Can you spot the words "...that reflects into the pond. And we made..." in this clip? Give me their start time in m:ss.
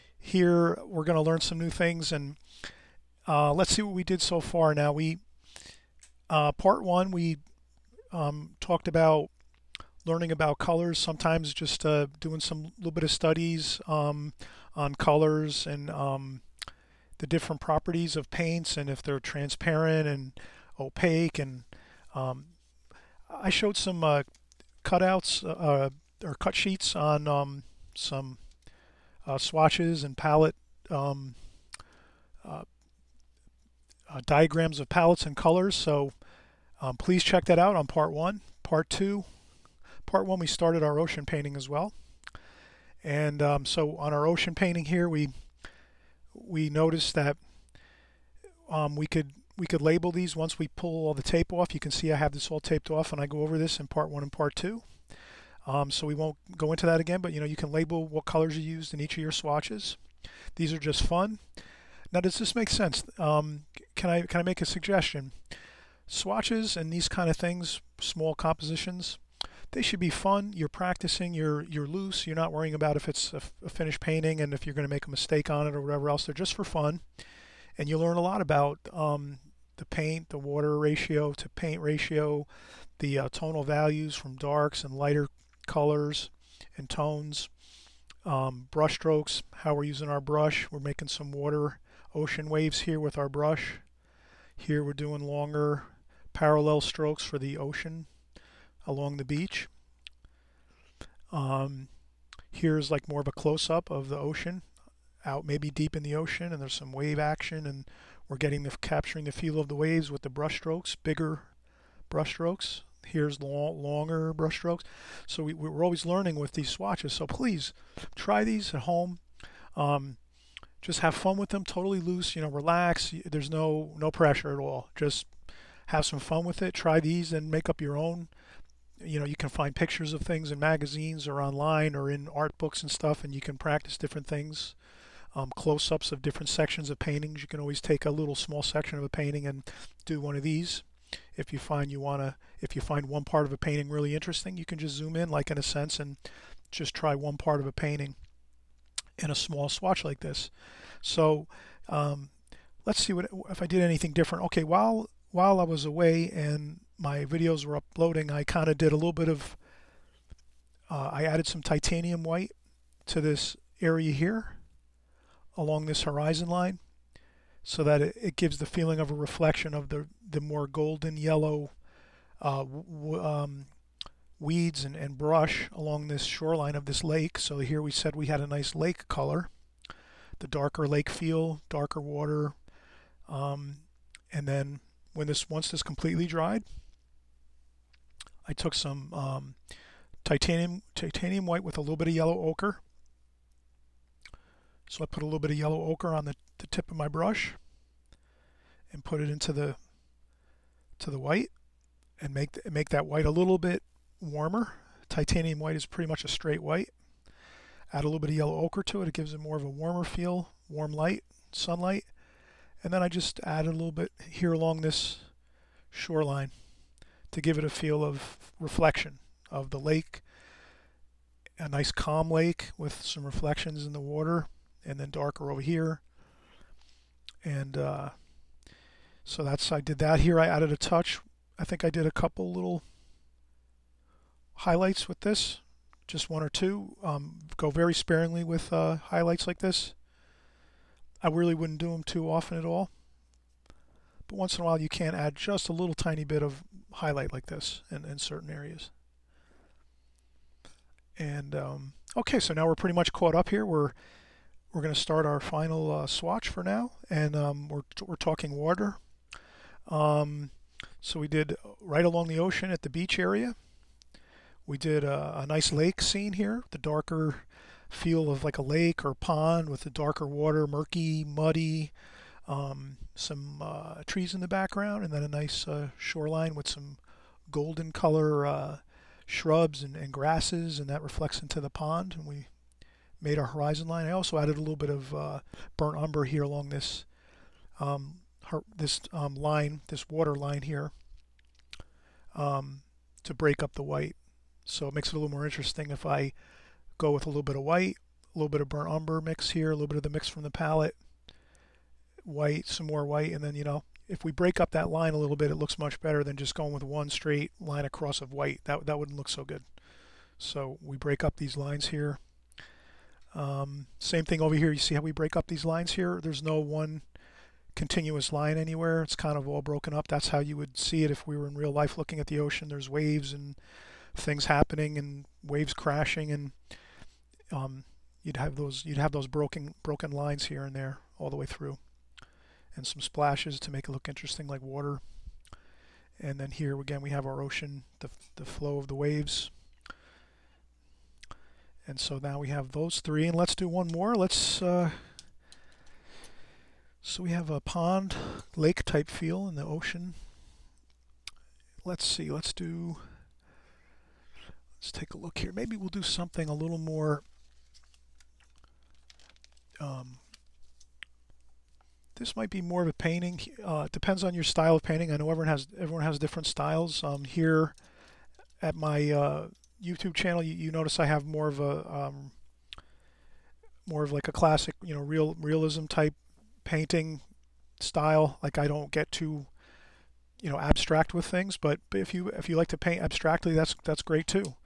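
4:40.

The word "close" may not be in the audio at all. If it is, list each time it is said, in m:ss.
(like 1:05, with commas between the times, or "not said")
1:43, 2:15.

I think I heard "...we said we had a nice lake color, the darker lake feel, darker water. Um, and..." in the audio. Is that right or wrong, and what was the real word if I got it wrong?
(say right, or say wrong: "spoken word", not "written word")
right.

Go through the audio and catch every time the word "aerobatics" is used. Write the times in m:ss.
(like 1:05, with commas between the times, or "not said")
not said.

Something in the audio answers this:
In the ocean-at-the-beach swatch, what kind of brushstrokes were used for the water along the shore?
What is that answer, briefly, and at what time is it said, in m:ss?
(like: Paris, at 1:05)
longer parallel strokes, at 1:35.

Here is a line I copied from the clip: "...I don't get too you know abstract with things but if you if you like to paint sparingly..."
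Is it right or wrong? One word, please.
wrong.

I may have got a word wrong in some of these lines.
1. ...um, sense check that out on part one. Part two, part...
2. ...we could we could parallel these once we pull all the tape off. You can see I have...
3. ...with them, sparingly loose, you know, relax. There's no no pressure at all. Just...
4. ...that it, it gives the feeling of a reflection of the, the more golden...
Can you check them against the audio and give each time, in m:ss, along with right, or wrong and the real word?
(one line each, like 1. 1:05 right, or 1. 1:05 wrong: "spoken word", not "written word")
1. 0:36 wrong: "please", not "sense"
2. 0:48 wrong: "label", not "parallel"
3. 2:01 wrong: "totally", not "sparingly"
4. 2:47 right.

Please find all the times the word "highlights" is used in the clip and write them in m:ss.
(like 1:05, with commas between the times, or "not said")
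3:54, 3:58, 4:06.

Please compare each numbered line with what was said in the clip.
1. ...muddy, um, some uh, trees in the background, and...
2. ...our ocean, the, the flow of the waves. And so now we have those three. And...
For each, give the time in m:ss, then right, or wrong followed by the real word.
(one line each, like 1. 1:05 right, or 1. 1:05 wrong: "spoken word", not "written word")
1. 4:31 right
2. 5:37 right.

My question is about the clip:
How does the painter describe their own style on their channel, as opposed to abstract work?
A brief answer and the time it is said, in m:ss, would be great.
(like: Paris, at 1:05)
realism, at 6:15.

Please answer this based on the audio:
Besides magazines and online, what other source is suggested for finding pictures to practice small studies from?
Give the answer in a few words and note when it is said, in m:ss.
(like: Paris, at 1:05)
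art books, at 2:12.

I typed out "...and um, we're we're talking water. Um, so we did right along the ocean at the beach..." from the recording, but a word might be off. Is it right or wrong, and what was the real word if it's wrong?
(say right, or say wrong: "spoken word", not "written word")
right.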